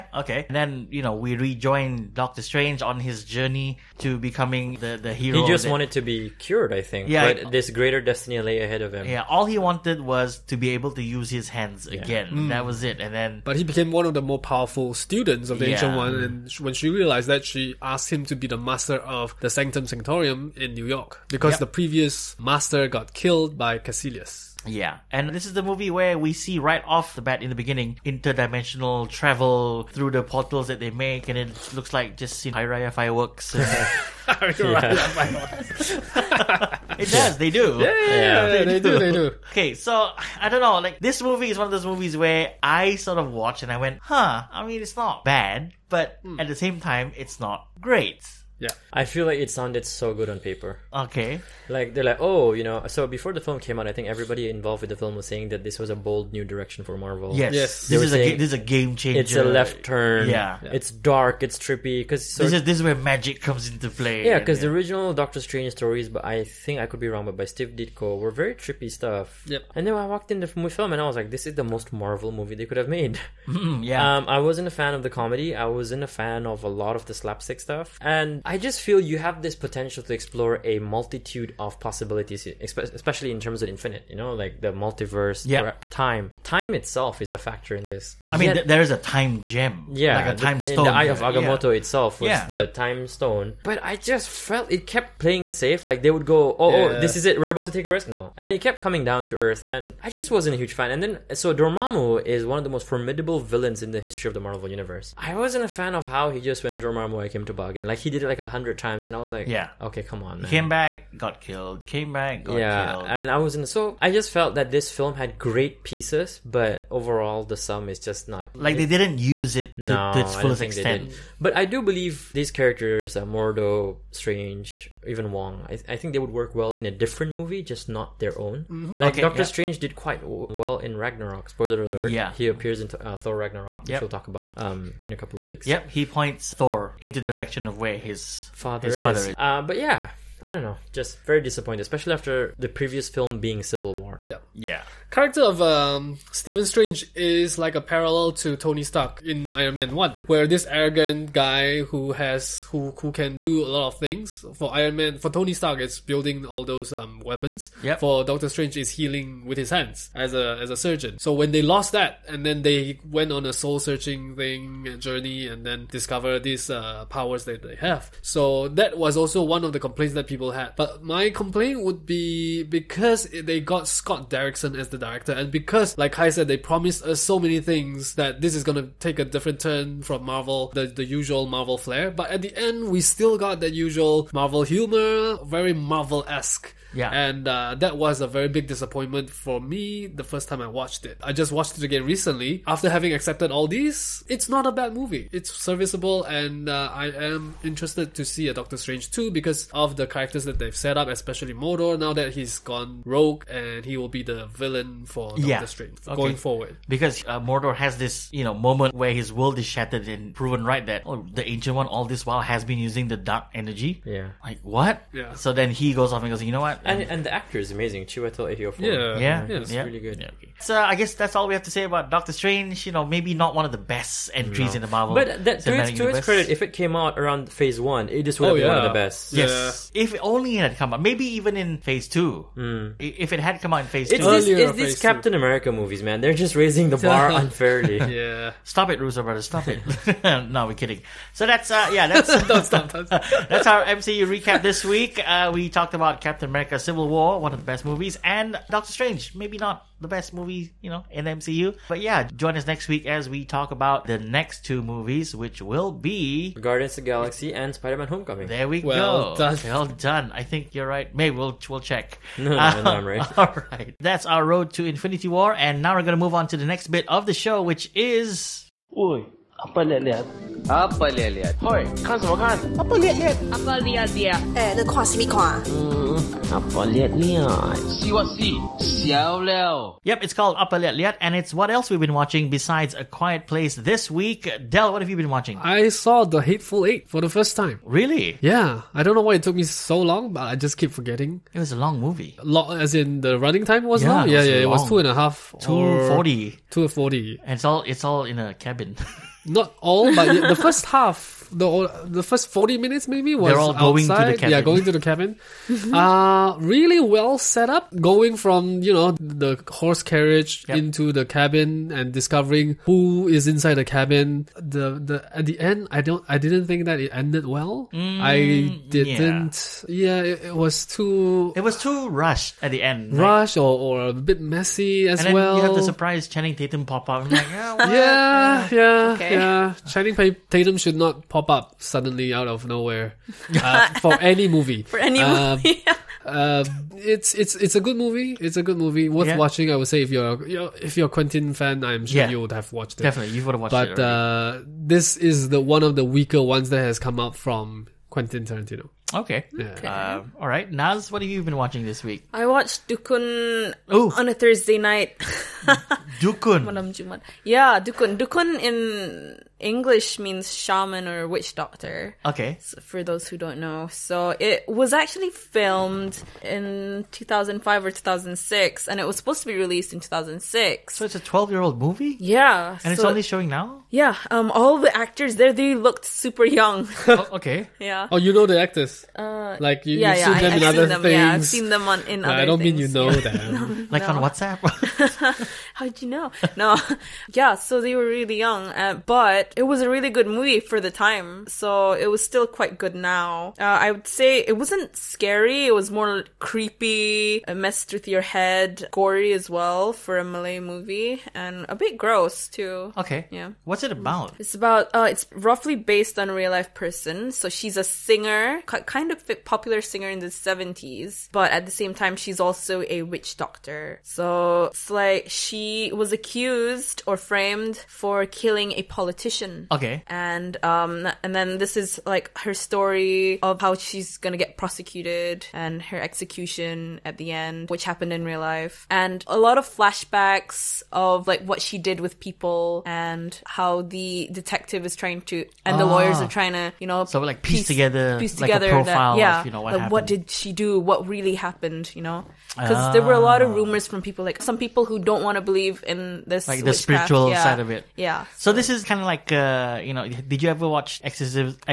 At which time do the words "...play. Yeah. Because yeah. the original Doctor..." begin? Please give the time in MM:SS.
01:03.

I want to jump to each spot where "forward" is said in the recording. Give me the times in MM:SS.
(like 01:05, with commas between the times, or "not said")
03:26.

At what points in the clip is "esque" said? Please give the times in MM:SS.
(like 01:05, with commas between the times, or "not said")
03:06.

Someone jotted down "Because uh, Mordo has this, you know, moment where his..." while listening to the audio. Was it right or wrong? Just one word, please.
right.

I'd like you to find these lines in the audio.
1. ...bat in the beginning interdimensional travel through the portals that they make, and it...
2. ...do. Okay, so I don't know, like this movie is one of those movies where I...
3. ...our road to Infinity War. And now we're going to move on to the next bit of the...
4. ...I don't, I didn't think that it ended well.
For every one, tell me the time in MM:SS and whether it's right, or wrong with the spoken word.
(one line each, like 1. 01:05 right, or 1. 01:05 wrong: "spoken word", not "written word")
1. 00:27 right
2. 00:39 right
3. 04:24 right
4. 05:15 right.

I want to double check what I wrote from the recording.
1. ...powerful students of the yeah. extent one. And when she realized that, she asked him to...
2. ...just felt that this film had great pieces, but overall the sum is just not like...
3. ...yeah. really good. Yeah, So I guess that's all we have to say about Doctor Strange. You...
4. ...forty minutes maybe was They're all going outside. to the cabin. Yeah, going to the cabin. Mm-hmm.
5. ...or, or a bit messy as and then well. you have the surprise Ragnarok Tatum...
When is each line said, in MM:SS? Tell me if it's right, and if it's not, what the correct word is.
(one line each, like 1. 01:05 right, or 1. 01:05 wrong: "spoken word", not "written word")
1. 00:14 wrong: "ancient", not "extent"
2. 01:54 right
3. 03:39 right
4. 05:02 right
5. 05:23 wrong: "Channing", not "Ragnarok".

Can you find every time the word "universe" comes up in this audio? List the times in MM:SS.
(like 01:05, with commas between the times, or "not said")
01:44.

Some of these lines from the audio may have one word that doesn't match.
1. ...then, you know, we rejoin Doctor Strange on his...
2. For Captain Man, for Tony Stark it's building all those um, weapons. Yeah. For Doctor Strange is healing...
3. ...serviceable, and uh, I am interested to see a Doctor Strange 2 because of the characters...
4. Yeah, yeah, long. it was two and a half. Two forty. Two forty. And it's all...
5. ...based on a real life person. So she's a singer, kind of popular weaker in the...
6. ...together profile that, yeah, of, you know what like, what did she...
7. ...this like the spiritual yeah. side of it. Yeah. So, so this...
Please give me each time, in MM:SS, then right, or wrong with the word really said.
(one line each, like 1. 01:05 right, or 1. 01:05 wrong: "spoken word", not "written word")
1. 00:00 right
2. 02:34 wrong: "Iron", not "Captain"
3. 03:15 right
4. 04:54 right
5. 06:45 wrong: "singer", not "weaker"
6. 07:18 right
7. 07:26 right.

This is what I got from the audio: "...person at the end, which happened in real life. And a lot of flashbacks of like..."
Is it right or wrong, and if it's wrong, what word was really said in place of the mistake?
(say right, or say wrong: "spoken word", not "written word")
wrong: "execution", not "person".